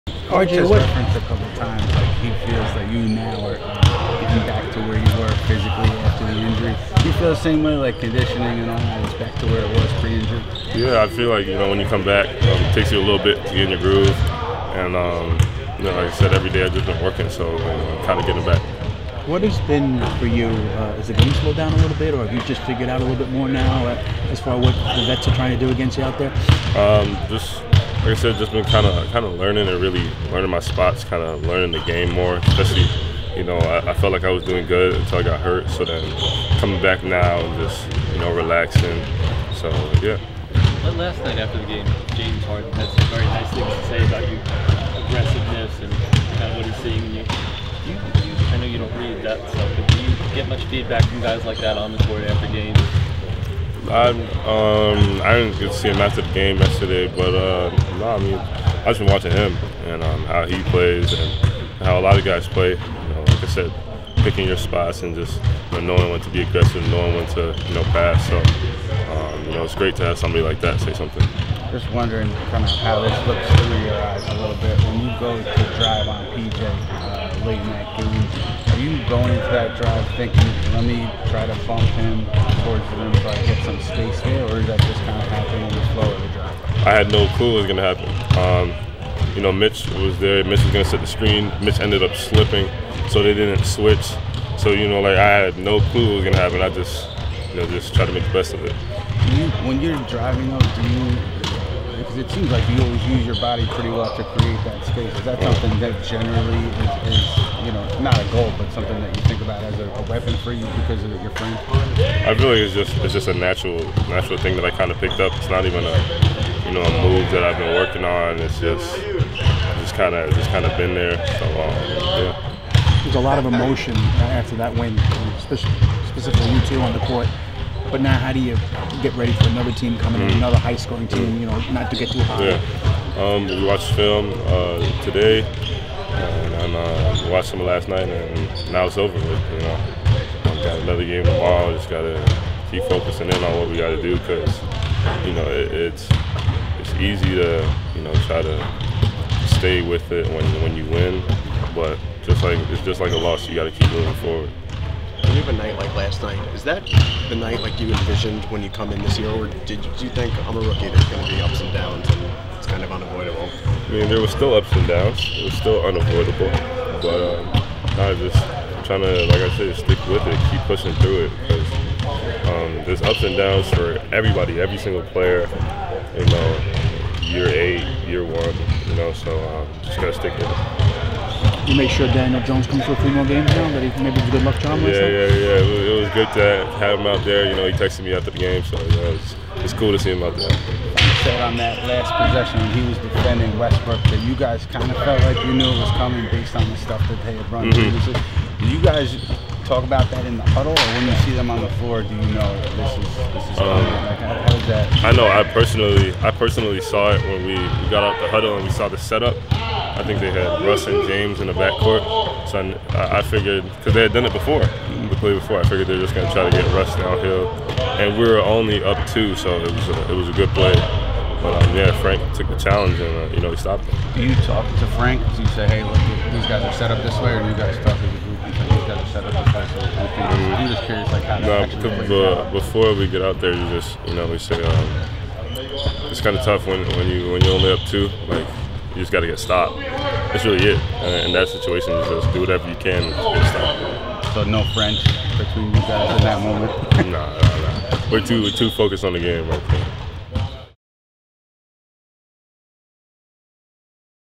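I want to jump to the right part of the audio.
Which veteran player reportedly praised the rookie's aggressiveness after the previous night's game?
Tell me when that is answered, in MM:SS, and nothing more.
00:42.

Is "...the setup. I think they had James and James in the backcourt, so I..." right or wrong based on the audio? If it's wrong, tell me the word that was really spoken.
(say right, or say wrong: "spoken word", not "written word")
wrong: "Russ", not "James".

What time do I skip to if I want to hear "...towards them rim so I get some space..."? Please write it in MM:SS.
01:22.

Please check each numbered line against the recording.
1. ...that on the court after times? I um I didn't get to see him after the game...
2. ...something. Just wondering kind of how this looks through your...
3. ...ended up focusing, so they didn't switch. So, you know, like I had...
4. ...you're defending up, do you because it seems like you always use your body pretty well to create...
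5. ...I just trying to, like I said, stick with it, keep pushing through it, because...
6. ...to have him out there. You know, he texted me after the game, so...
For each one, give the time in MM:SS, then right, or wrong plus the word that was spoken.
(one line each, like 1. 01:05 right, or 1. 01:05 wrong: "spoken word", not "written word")
1. 00:51 wrong: "games", not "times"
2. 01:10 right
3. 01:31 wrong: "slipping", not "focusing"
4. 01:39 wrong: "driving", not "defending"
5. 02:47 right
6. 03:06 right.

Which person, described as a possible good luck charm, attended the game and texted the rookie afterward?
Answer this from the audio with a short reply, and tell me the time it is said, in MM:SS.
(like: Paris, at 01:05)
Daniel Jones, at 03:02.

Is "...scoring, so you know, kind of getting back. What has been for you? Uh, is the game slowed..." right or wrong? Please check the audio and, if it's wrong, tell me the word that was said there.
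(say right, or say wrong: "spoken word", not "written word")
wrong: "working", not "scoring".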